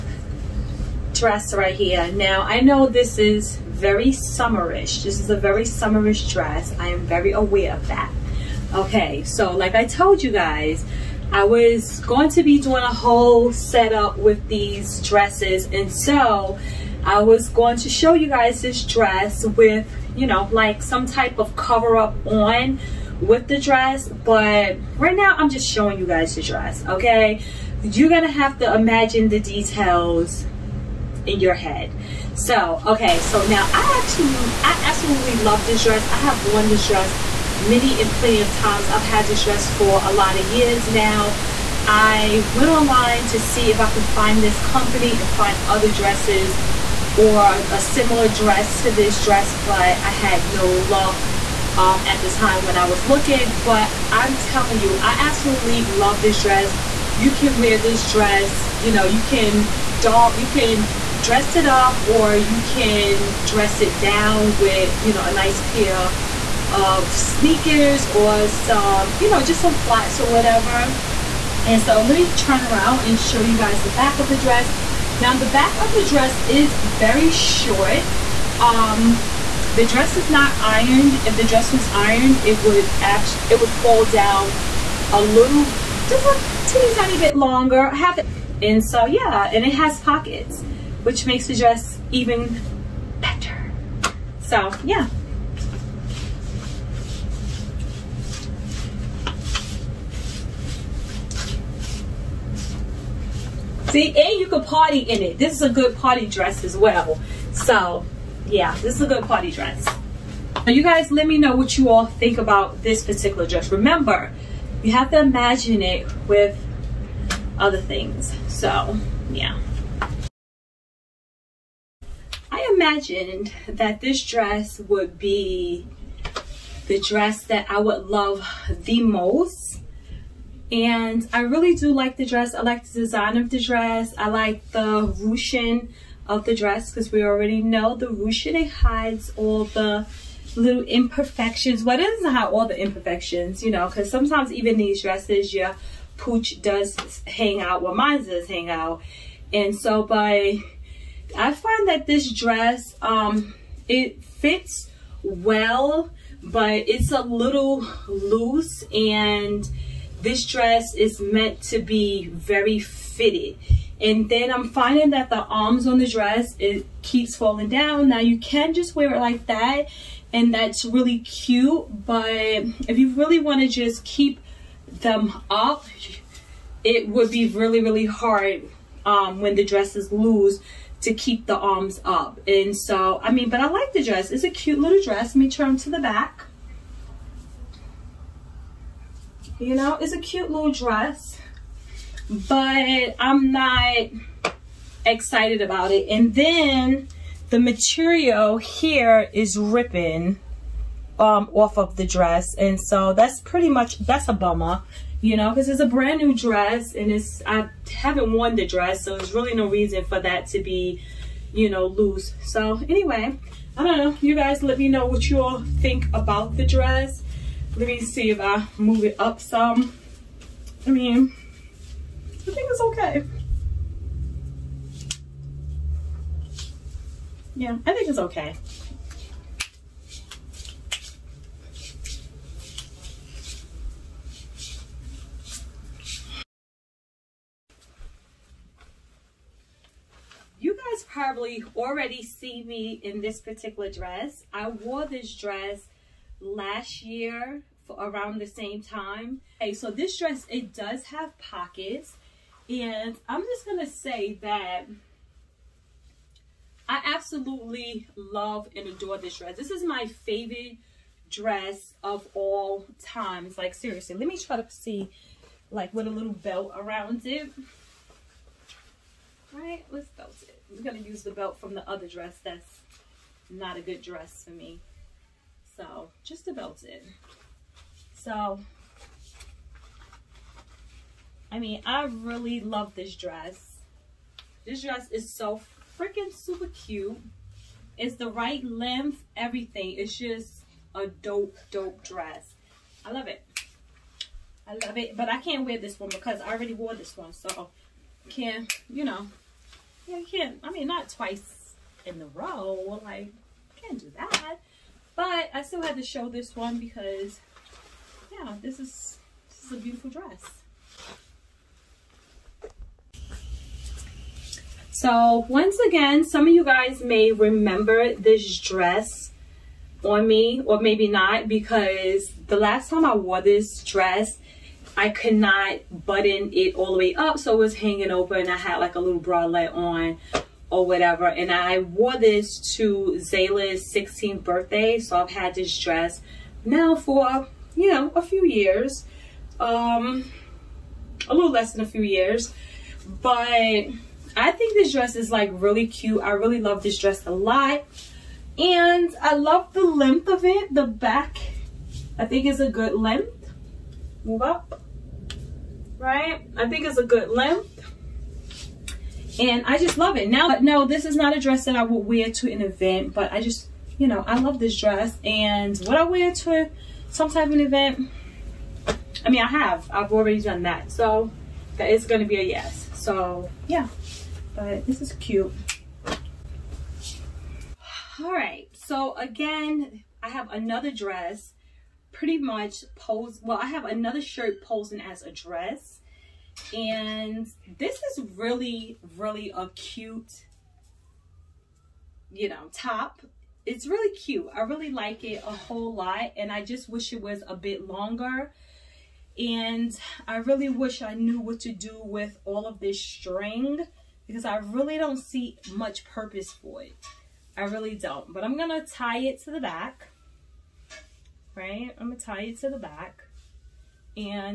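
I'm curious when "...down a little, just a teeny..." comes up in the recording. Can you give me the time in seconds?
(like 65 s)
84 s.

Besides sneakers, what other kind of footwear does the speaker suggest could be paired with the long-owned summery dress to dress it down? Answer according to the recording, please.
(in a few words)
flats.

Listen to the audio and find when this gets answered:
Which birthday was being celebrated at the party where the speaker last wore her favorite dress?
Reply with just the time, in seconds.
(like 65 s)
333 s.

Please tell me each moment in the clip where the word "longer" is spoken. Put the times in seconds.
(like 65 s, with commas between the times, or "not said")
87 s, 397 s.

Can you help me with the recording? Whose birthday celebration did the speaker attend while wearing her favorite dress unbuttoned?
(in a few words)
Zayla's.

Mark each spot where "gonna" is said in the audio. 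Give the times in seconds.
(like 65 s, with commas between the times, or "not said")
28 s.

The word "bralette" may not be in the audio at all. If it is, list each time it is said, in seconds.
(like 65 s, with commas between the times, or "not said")
329 s.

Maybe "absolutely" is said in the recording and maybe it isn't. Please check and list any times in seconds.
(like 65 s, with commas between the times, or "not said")
34 s, 55 s, 257 s.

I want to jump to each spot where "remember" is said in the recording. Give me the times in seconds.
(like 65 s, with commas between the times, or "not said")
113 s, 317 s.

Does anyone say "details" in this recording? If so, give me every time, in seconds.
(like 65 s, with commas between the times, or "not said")
29 s.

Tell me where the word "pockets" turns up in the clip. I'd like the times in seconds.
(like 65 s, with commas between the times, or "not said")
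89 s, 251 s.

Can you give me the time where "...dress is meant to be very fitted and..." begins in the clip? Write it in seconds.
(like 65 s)
160 s.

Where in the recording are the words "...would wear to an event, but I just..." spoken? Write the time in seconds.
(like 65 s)
361 s.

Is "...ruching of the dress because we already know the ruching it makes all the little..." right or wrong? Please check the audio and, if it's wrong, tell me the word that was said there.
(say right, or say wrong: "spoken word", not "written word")
wrong: "hides", not "makes".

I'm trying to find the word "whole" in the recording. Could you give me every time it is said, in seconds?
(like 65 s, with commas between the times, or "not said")
12 s, 395 s.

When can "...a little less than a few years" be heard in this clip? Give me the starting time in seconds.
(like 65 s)
341 s.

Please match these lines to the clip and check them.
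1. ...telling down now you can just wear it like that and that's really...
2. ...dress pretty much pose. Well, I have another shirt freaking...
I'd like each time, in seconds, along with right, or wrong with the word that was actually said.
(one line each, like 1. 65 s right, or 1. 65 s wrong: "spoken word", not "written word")
1. 167 s wrong: "falling", not "telling"
2. 380 s wrong: "posing", not "freaking".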